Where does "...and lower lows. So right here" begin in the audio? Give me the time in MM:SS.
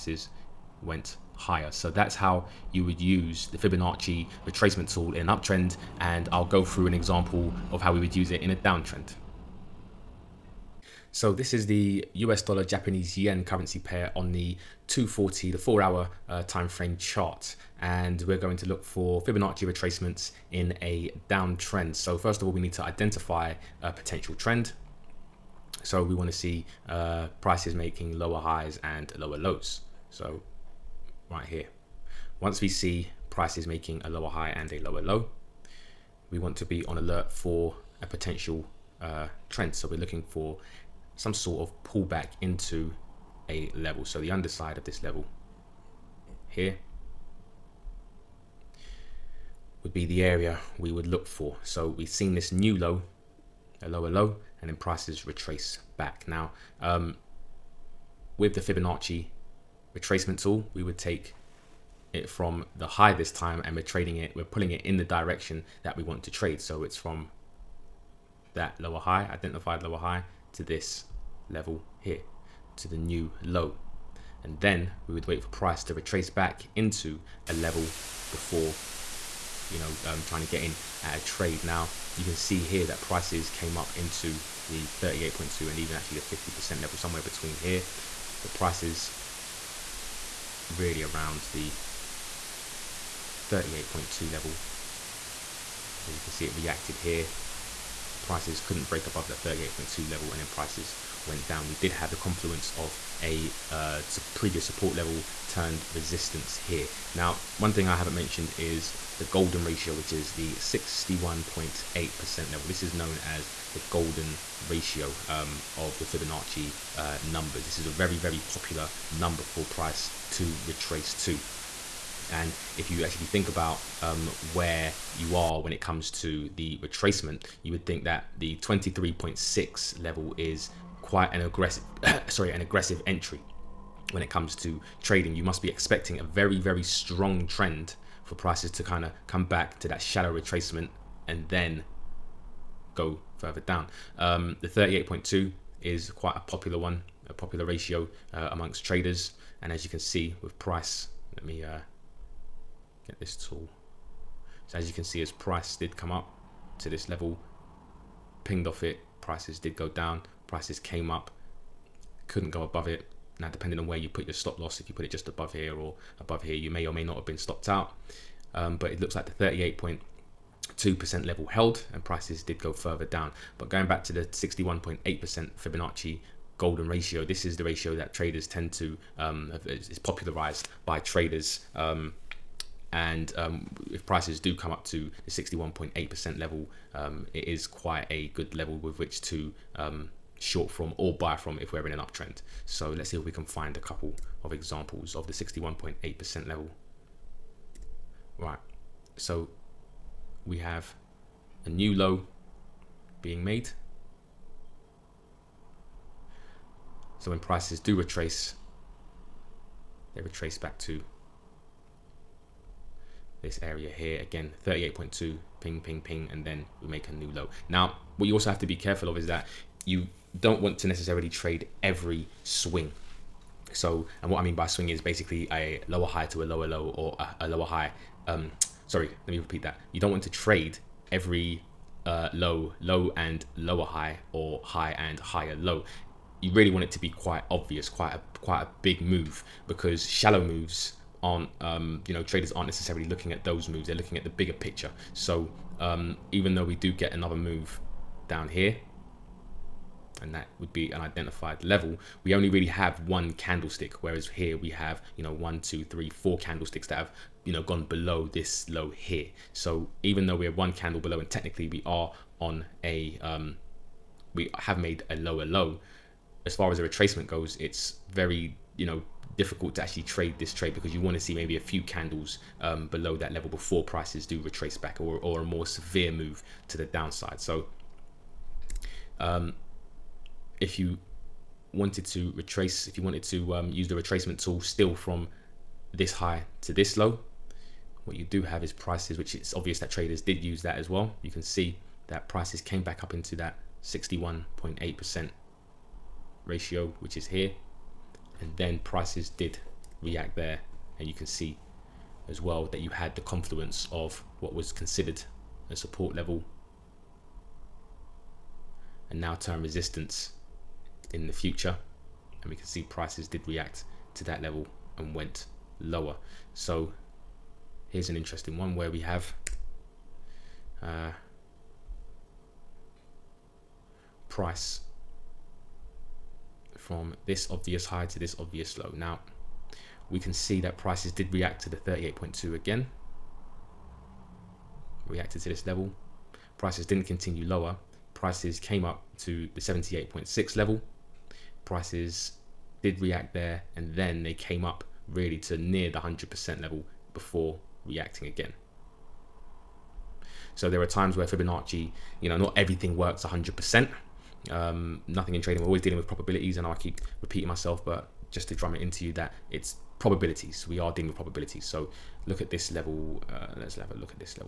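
00:28.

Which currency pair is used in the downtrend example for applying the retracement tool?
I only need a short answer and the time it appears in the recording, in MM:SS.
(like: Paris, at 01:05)
US dollar Japanese yen, at 00:12.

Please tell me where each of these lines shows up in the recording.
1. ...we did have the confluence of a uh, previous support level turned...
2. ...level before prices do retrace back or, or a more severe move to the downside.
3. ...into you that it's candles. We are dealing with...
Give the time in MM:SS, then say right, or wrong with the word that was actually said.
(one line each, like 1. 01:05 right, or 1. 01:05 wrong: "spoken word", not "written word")
1. 01:41 right
2. 04:33 right
3. 05:58 wrong: "probabilities", not "candles".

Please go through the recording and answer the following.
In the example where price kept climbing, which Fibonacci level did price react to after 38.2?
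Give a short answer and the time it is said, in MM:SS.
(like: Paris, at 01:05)
78.6, at 05:39.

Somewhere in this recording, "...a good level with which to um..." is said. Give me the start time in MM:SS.
03:08.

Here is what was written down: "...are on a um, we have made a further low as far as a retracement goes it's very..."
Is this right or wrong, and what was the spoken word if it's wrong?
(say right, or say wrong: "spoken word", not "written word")
wrong: "lower", not "further".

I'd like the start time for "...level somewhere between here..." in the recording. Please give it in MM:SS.
01:26.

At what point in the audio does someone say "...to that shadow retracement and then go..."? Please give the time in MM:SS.
02:19.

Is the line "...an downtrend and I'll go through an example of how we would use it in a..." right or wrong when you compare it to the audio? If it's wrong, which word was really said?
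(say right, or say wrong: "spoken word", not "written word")
wrong: "uptrend", not "downtrend".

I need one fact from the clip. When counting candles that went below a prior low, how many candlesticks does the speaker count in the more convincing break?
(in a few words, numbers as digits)
4.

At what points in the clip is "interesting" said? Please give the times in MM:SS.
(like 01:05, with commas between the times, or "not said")
05:18.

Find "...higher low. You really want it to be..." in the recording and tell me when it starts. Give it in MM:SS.
03:55.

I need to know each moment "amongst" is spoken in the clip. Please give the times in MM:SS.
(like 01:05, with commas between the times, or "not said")
02:28.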